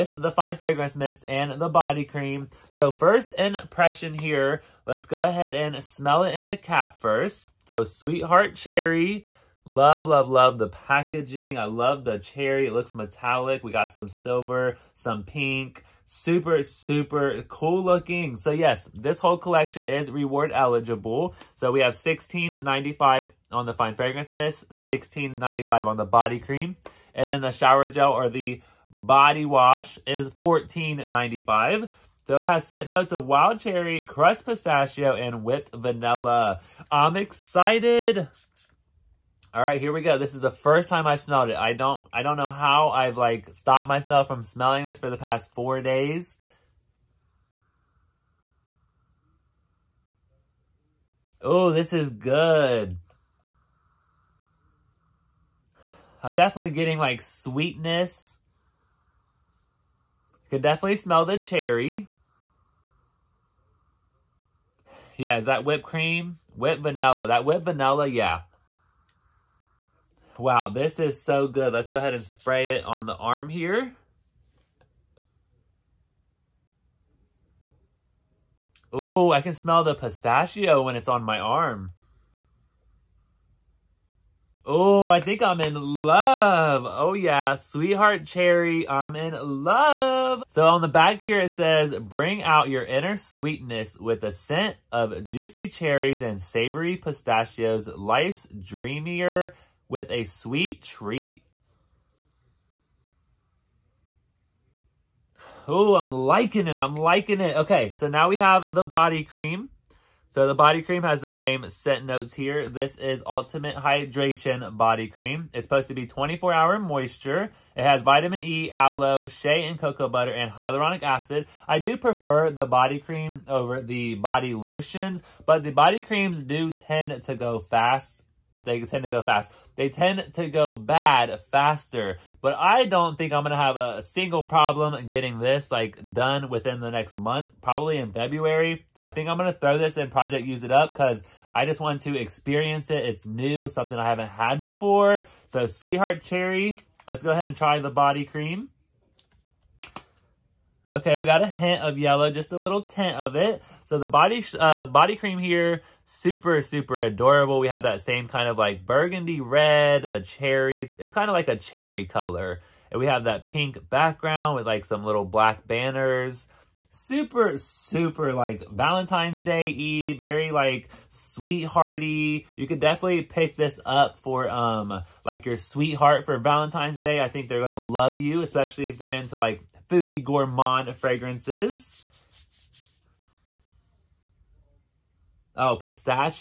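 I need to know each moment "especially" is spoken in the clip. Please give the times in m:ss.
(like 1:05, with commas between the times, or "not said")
2:58.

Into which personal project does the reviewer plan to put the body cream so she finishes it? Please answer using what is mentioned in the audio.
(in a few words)
Project Use It Up.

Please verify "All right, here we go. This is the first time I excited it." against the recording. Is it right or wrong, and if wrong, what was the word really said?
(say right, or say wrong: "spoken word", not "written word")
wrong: "smelled", not "excited".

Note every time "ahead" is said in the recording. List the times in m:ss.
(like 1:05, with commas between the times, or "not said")
0:05, 1:11, 2:27.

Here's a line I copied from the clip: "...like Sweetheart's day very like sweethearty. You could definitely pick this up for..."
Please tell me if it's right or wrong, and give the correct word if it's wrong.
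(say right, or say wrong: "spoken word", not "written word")
wrong: "Valentine", not "Sweetheart".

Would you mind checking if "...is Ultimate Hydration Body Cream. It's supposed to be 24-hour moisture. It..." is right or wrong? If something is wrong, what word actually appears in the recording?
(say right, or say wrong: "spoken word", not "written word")
right.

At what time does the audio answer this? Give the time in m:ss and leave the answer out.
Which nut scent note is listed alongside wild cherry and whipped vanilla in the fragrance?
0:34.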